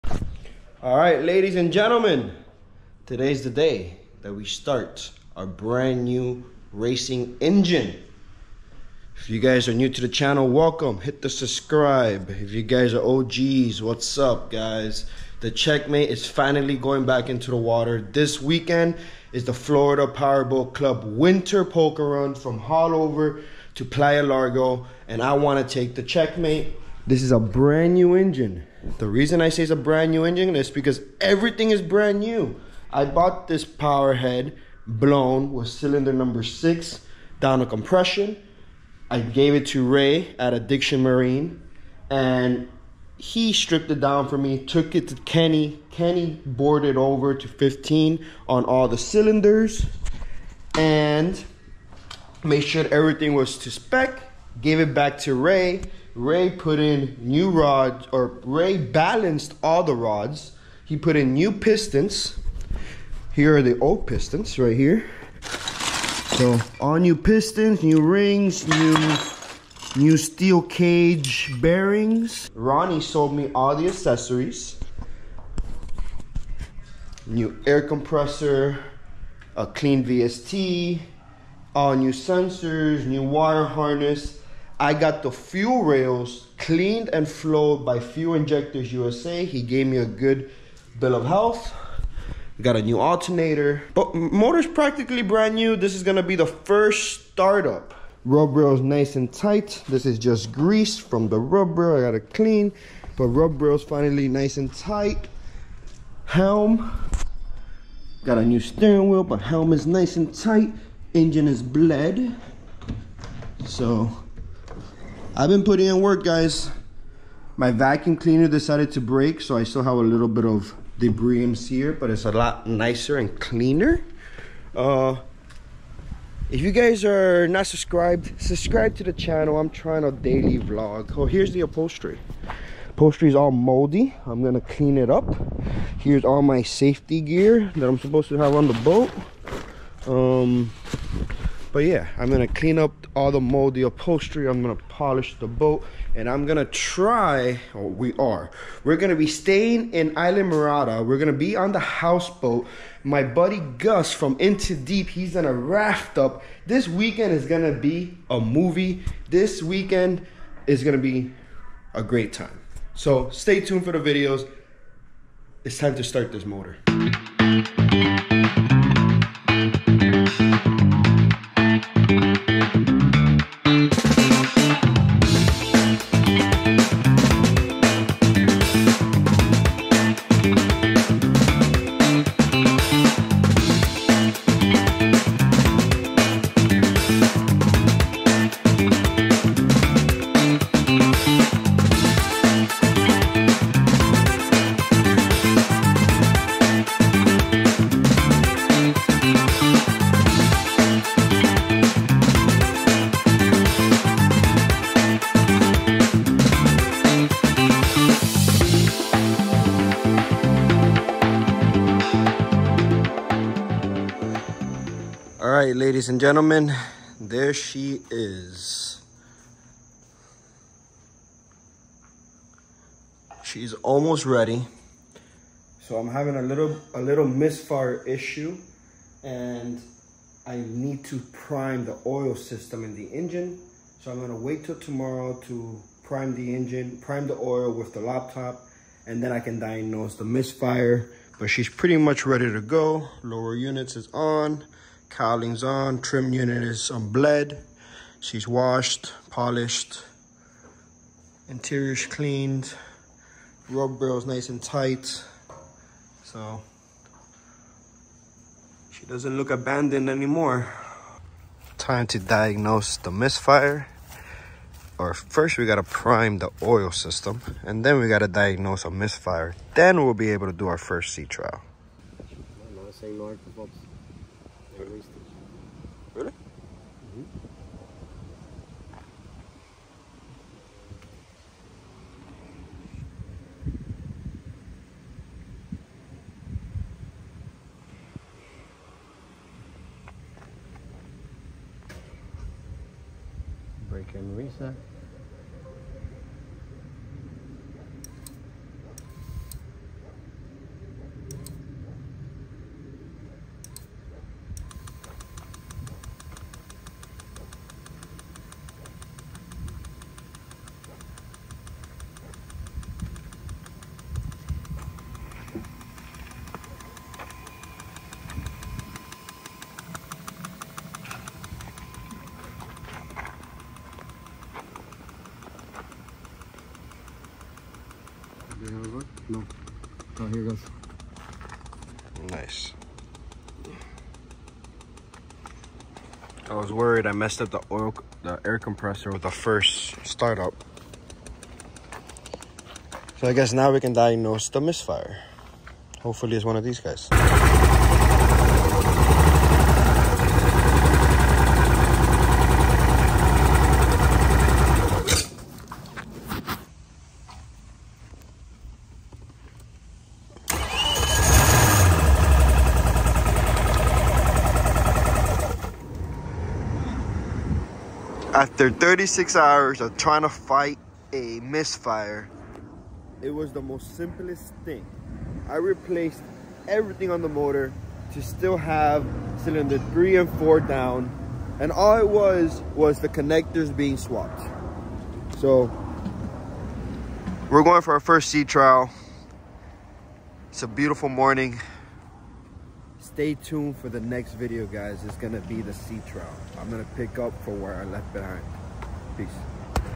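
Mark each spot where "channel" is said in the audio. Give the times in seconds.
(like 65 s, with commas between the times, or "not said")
10 s, 129 s.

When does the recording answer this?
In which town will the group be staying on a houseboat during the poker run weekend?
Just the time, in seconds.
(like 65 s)
150 s.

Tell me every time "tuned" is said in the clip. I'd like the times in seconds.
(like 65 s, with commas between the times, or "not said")
163 s, 393 s.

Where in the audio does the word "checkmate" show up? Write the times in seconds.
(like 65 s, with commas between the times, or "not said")
15 s, 26 s.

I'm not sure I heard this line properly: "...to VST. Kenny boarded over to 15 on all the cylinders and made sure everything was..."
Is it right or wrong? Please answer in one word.
wrong.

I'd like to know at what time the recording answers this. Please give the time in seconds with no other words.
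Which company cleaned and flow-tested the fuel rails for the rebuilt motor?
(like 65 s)
87 s.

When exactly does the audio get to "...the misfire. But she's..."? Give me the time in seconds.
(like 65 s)
240 s.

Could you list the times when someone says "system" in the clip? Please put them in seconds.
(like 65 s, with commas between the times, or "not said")
232 s, 266 s.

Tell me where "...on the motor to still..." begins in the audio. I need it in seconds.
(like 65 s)
377 s.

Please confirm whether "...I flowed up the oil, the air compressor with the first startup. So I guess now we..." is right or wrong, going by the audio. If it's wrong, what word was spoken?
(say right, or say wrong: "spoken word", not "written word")
wrong: "messed", not "flowed".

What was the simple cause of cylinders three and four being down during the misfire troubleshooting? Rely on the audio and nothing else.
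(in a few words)
connectors being swapped.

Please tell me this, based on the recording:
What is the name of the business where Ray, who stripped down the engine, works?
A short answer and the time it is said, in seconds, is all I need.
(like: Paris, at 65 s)
Addiction Marine, at 40 s.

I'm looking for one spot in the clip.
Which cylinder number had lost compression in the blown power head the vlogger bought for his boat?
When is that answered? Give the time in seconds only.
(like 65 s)
35 s.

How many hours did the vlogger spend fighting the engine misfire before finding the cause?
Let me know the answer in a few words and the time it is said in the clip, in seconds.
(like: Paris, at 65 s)
36, at 368 s.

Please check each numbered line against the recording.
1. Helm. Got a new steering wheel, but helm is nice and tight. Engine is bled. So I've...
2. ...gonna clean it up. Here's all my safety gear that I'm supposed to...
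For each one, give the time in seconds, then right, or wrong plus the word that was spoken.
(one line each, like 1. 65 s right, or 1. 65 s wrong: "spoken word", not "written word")
1. 106 s right
2. 134 s right.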